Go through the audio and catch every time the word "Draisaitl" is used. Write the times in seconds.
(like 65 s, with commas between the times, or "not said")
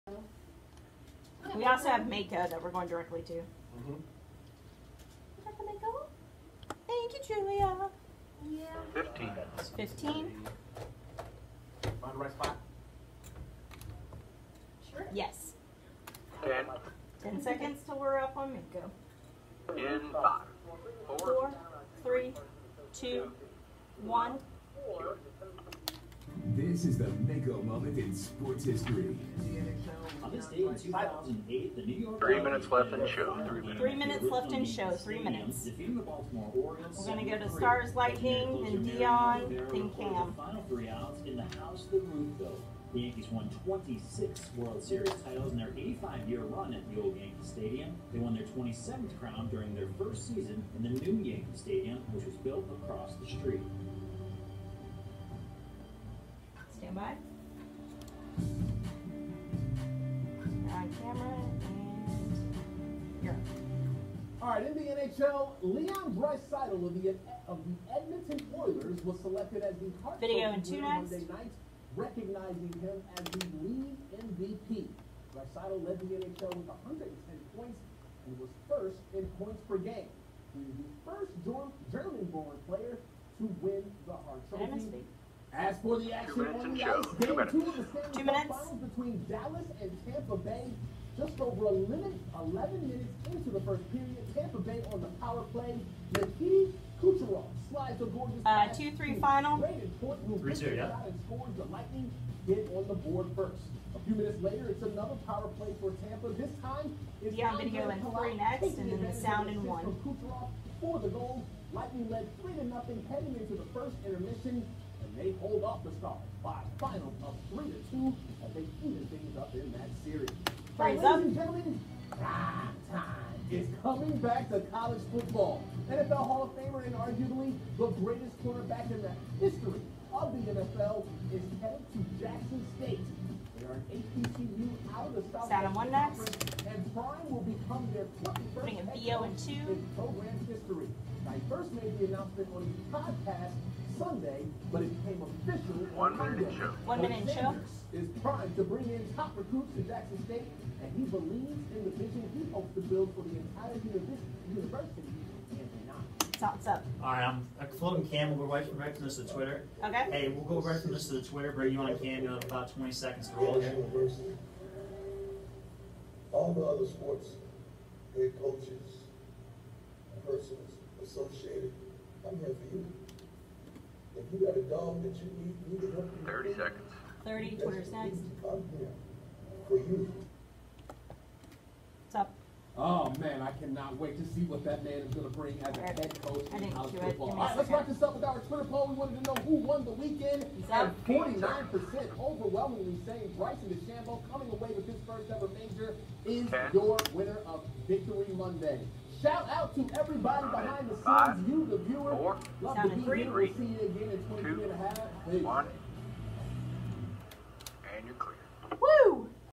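66 s, 75 s.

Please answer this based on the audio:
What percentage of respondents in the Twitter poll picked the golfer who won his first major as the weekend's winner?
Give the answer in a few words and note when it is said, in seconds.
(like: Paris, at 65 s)
49%, at 191 s.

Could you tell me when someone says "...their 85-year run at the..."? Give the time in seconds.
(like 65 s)
45 s.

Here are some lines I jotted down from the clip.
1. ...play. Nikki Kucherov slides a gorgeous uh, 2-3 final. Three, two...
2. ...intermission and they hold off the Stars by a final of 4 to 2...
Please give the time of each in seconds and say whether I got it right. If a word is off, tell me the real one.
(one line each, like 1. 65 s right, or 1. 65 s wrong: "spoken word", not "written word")
1. 95 s right
2. 114 s wrong: "3", not "4".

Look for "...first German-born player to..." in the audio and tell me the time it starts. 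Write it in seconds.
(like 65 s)
81 s.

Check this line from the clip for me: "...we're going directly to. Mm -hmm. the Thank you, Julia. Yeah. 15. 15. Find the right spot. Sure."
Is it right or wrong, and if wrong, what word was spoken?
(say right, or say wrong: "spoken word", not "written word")
right.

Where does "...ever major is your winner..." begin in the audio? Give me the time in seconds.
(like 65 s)
195 s.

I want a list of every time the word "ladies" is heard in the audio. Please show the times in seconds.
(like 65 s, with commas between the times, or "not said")
120 s.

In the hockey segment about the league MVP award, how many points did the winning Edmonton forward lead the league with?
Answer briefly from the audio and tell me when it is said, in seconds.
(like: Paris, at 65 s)
110, at 76 s.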